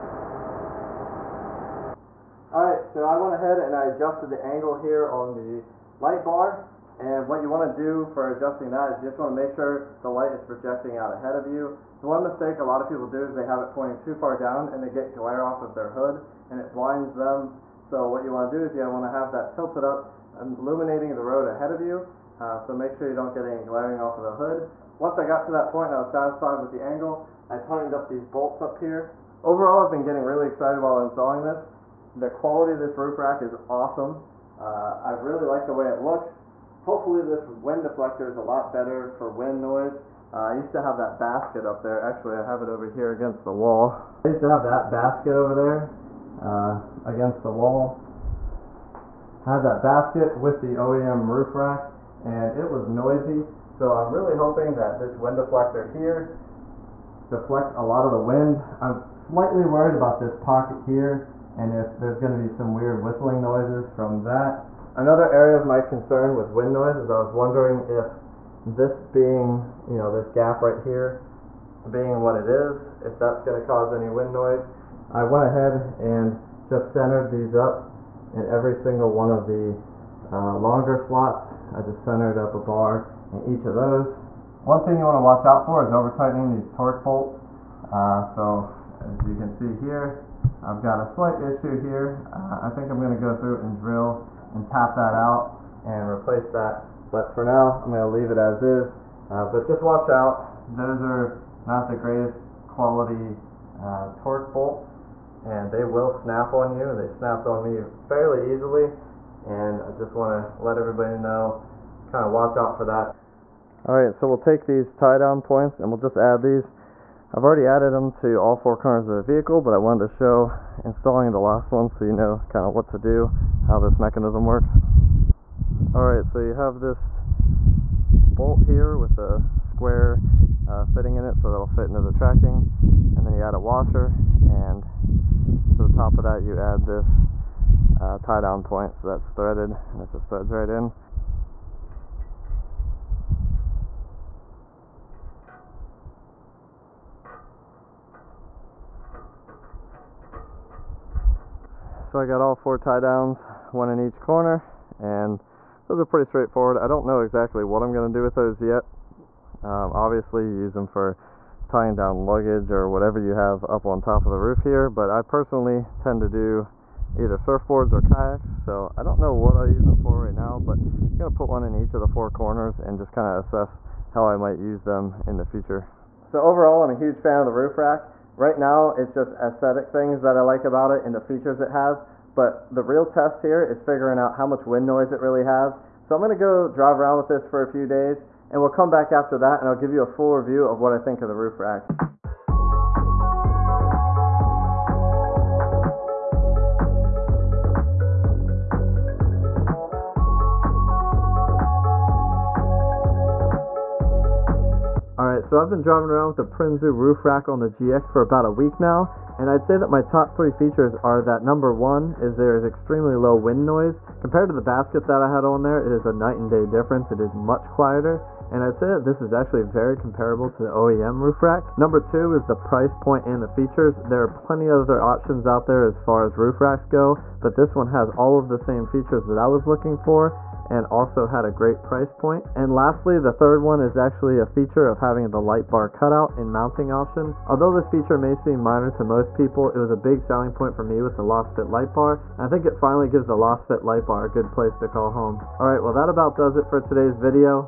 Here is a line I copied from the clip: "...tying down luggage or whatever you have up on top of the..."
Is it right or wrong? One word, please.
right.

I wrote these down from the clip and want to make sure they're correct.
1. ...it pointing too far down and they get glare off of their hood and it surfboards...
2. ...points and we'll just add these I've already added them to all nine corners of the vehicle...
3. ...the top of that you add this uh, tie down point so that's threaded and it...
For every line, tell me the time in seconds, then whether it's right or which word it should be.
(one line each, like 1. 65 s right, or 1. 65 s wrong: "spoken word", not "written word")
1. 13 s wrong: "blinds", not "surfboards"
2. 115 s wrong: "four", not "nine"
3. 135 s right.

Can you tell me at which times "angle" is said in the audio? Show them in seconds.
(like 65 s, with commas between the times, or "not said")
4 s, 26 s.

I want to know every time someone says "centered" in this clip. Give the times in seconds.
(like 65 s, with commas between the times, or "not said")
76 s, 82 s.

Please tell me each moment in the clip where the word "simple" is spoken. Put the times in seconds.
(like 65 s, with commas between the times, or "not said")
not said.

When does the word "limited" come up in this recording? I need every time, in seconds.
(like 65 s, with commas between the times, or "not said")
not said.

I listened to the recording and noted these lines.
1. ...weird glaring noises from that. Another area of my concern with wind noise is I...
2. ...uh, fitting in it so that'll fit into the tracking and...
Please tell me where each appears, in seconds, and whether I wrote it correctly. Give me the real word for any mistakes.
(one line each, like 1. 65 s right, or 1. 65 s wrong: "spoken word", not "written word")
1. 62 s wrong: "whistling", not "glaring"
2. 130 s right.